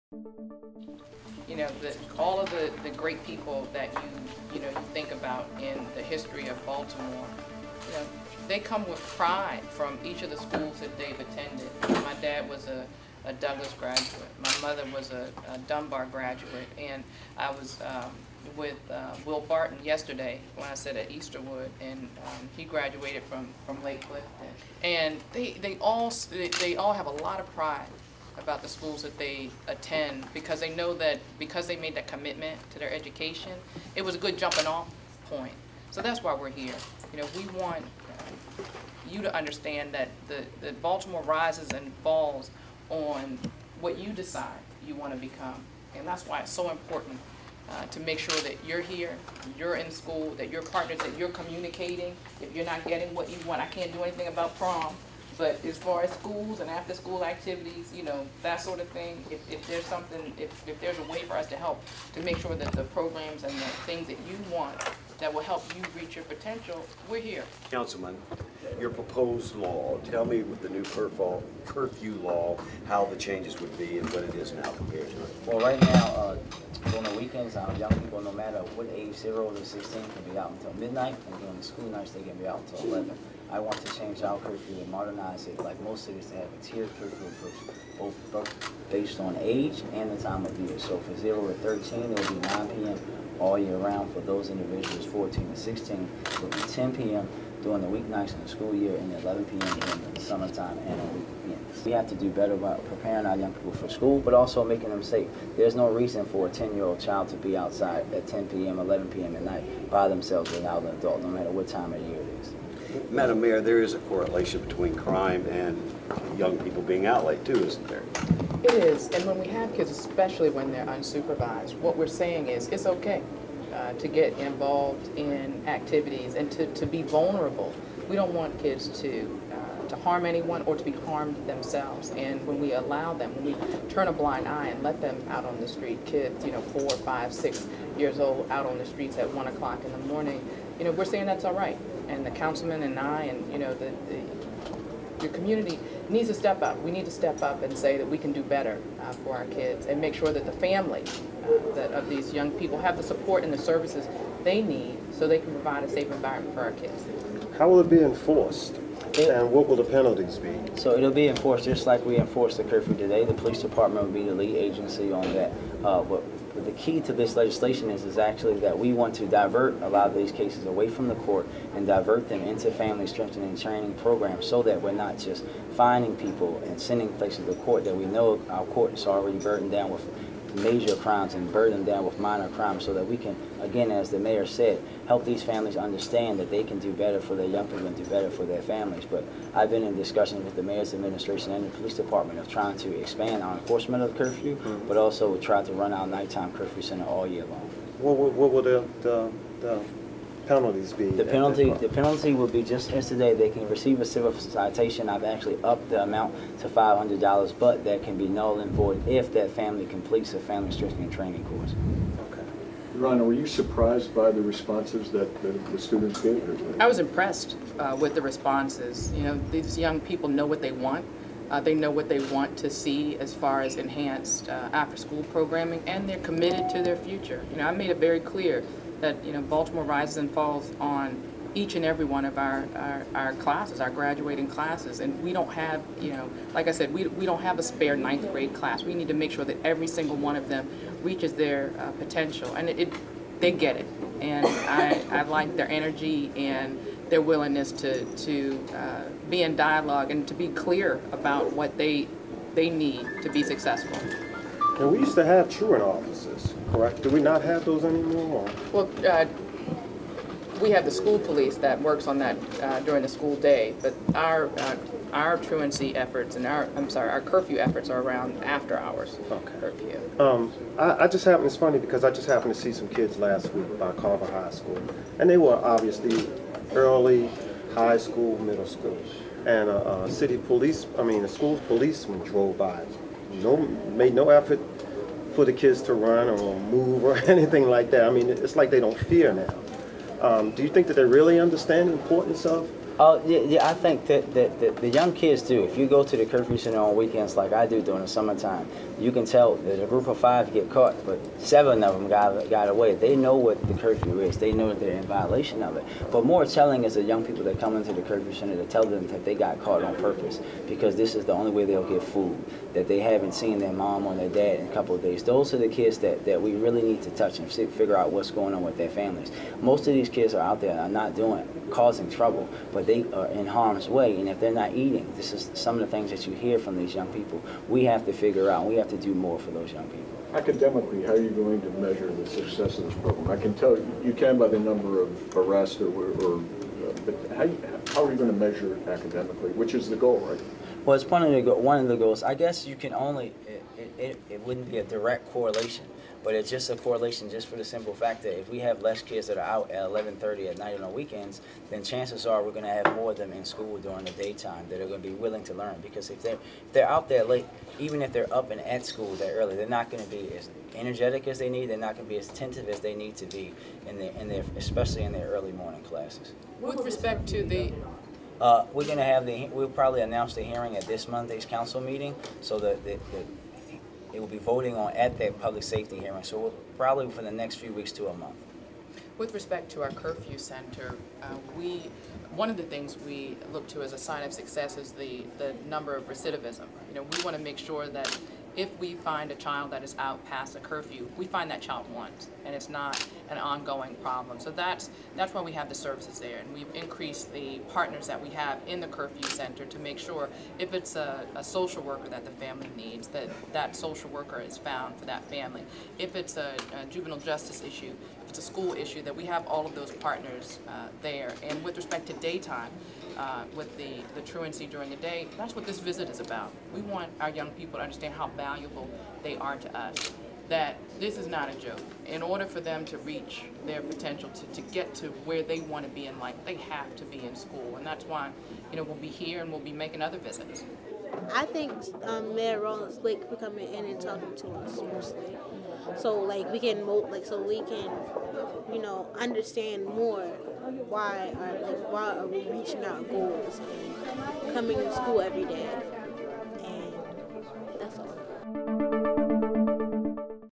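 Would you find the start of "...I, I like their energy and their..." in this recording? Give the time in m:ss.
4:04.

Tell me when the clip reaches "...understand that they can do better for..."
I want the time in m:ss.
3:05.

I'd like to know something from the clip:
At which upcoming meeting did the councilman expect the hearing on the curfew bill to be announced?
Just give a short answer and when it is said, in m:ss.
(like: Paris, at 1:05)
Monday's council meeting, at 6:11.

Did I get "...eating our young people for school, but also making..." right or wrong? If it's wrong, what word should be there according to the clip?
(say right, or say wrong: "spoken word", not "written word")
wrong: "preparing", not "eating".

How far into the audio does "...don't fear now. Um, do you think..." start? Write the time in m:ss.
4:48.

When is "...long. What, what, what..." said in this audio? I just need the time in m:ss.
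3:17.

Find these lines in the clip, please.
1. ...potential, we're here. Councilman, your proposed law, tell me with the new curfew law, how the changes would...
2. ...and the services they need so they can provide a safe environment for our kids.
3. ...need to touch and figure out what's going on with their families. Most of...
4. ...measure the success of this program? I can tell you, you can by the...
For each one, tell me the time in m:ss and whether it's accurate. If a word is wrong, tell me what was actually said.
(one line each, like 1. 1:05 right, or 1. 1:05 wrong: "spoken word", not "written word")
1. 1:06 right
2. 2:33 right
3. 5:16 right
4. 5:31 right.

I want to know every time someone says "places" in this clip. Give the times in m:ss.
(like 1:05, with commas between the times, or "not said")
2:57.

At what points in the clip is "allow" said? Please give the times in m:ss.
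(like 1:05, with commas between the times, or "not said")
2:12.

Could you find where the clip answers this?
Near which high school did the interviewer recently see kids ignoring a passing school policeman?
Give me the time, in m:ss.
4:33.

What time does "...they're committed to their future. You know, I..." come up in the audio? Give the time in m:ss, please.
3:46.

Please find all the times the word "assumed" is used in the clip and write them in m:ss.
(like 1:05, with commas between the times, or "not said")
not said.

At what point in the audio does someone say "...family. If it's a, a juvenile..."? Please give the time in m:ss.
6:45.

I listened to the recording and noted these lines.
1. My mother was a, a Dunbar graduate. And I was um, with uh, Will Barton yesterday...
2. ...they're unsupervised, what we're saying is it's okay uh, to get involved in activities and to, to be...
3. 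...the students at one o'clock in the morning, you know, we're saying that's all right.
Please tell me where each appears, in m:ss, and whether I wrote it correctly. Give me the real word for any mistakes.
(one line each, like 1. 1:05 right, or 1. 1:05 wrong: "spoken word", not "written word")
1. 0:14 right
2. 2:00 right
3. 2:18 wrong: "streets", not "students".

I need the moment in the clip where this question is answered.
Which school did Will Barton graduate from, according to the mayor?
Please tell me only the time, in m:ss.
0:23.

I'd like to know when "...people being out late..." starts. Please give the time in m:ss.
1:56.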